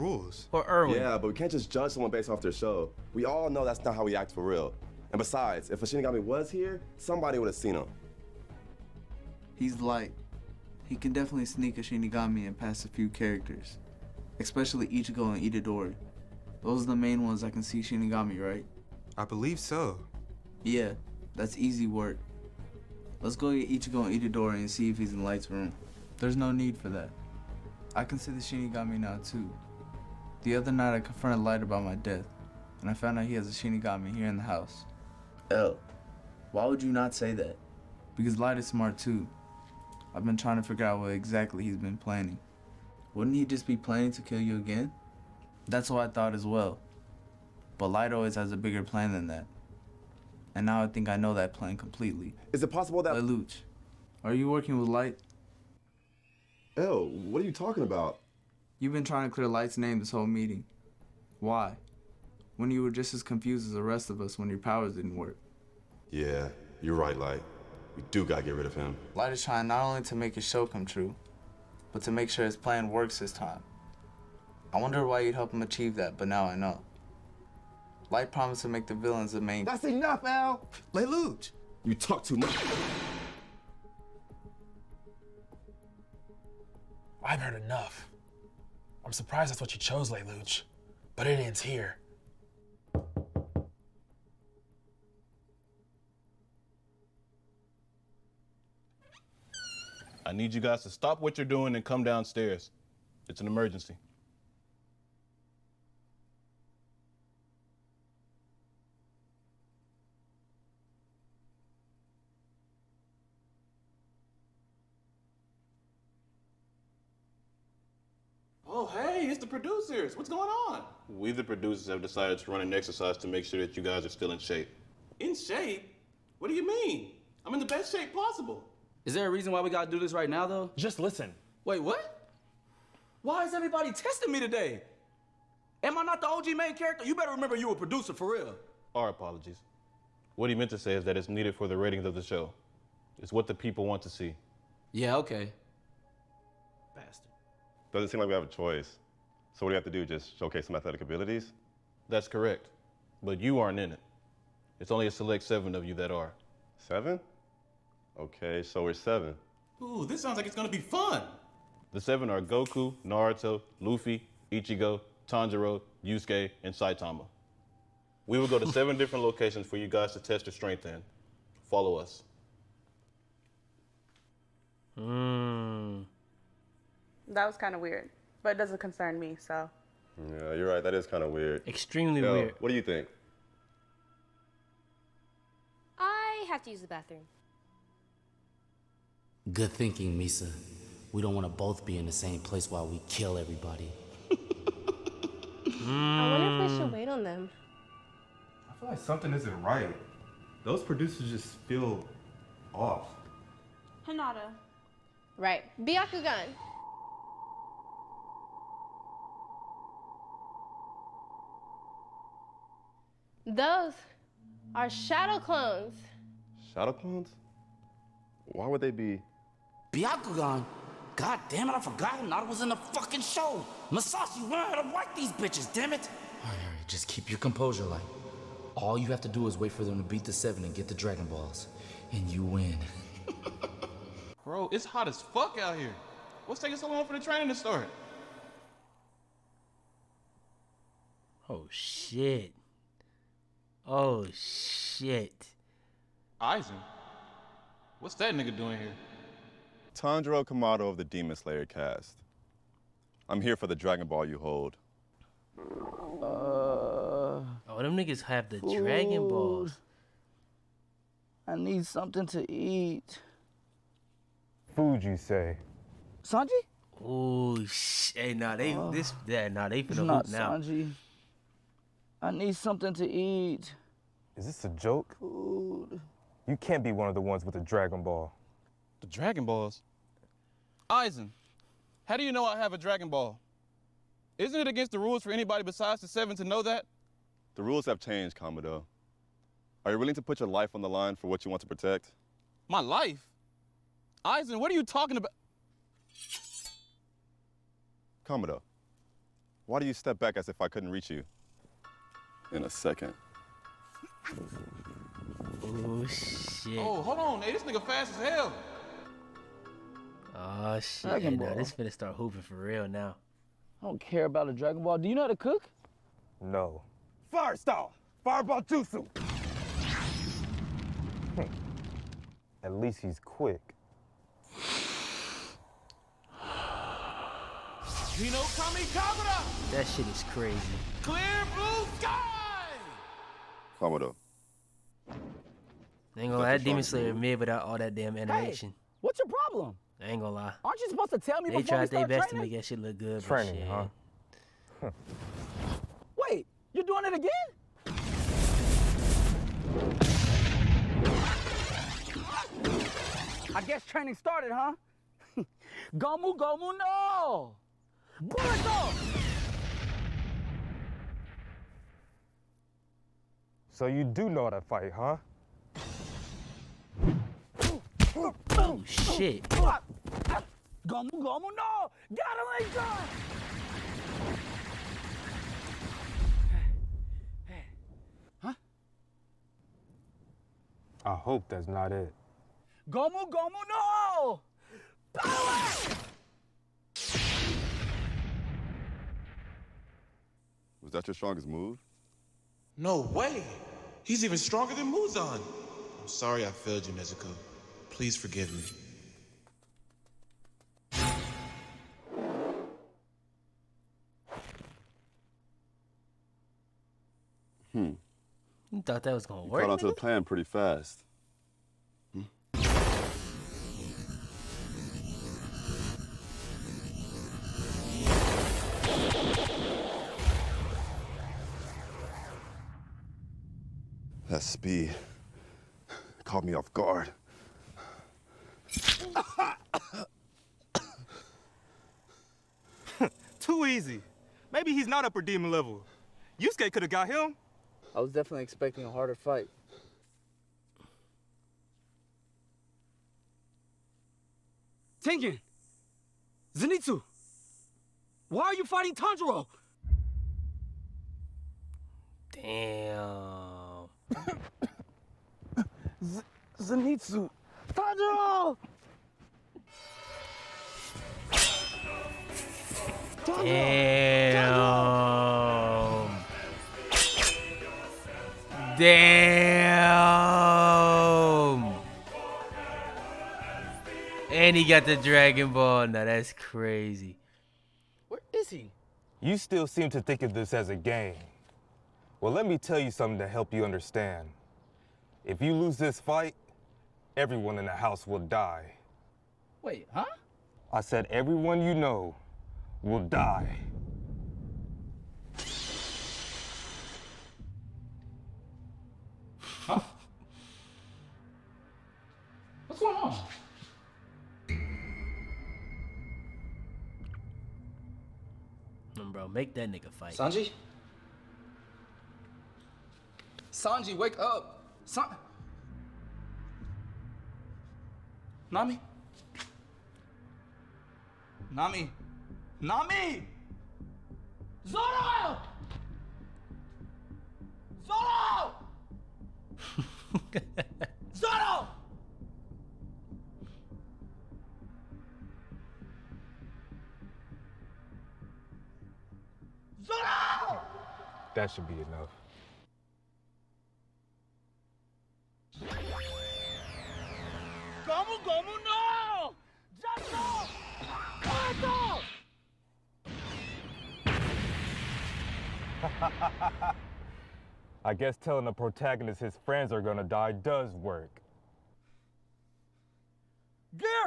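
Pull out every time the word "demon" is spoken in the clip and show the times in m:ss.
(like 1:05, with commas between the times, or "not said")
4:11, 5:36, 7:15.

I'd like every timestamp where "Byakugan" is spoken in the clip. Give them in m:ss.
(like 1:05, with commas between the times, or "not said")
3:25, 3:39.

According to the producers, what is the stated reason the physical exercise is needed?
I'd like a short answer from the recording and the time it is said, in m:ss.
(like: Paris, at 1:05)
The ratings, at 2:21.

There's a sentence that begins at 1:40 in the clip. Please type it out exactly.
I need you guys to stop what you're doing and come downstairs.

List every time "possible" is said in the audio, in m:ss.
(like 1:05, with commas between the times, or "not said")
0:52, 2:08.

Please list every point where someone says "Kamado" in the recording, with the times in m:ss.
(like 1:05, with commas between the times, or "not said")
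4:10, 4:48, 4:58, 5:33.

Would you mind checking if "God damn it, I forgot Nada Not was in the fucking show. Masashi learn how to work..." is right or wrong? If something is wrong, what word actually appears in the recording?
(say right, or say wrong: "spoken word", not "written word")
right.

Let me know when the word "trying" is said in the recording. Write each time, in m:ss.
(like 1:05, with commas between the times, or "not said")
0:40, 0:59, 1:09.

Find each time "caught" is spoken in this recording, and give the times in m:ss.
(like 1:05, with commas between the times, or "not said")
6:49, 7:06.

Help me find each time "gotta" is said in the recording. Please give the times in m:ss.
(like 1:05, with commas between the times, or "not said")
1:08, 2:09, 6:12.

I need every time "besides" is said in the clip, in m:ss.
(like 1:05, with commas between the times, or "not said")
0:05, 4:45.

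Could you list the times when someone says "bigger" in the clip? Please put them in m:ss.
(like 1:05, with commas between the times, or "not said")
0:48.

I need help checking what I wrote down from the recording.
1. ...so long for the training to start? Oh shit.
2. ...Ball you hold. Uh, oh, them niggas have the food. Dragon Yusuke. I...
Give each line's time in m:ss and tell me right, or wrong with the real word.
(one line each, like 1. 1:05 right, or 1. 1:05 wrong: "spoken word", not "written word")
1. 3:56 right
2. 4:14 wrong: "Balls", not "Yusuke".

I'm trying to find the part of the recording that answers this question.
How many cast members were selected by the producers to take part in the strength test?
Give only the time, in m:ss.
2:35.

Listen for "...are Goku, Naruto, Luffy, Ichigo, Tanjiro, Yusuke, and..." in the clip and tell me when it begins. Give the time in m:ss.
2:42.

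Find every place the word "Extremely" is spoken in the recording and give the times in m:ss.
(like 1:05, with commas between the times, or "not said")
3:01.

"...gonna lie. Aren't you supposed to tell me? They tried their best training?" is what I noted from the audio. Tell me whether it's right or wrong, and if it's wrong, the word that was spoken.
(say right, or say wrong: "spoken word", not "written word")
right.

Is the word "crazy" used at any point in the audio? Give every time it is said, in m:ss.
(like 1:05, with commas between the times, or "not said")
5:30, 7:56.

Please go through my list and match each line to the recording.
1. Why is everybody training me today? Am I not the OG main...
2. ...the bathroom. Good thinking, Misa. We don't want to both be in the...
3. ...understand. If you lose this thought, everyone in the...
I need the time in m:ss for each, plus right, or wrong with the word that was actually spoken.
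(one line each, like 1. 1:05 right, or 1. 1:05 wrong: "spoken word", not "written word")
1. 2:13 wrong: "testing", not "training"
2. 3:06 right
3. 8:03 wrong: "fight", not "thought".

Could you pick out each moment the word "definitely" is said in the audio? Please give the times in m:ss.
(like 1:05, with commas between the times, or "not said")
0:11, 7:18.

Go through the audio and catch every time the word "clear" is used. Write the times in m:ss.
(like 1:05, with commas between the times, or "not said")
0:59, 5:31.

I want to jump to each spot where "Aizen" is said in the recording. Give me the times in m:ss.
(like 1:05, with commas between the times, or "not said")
4:06, 4:40, 4:54.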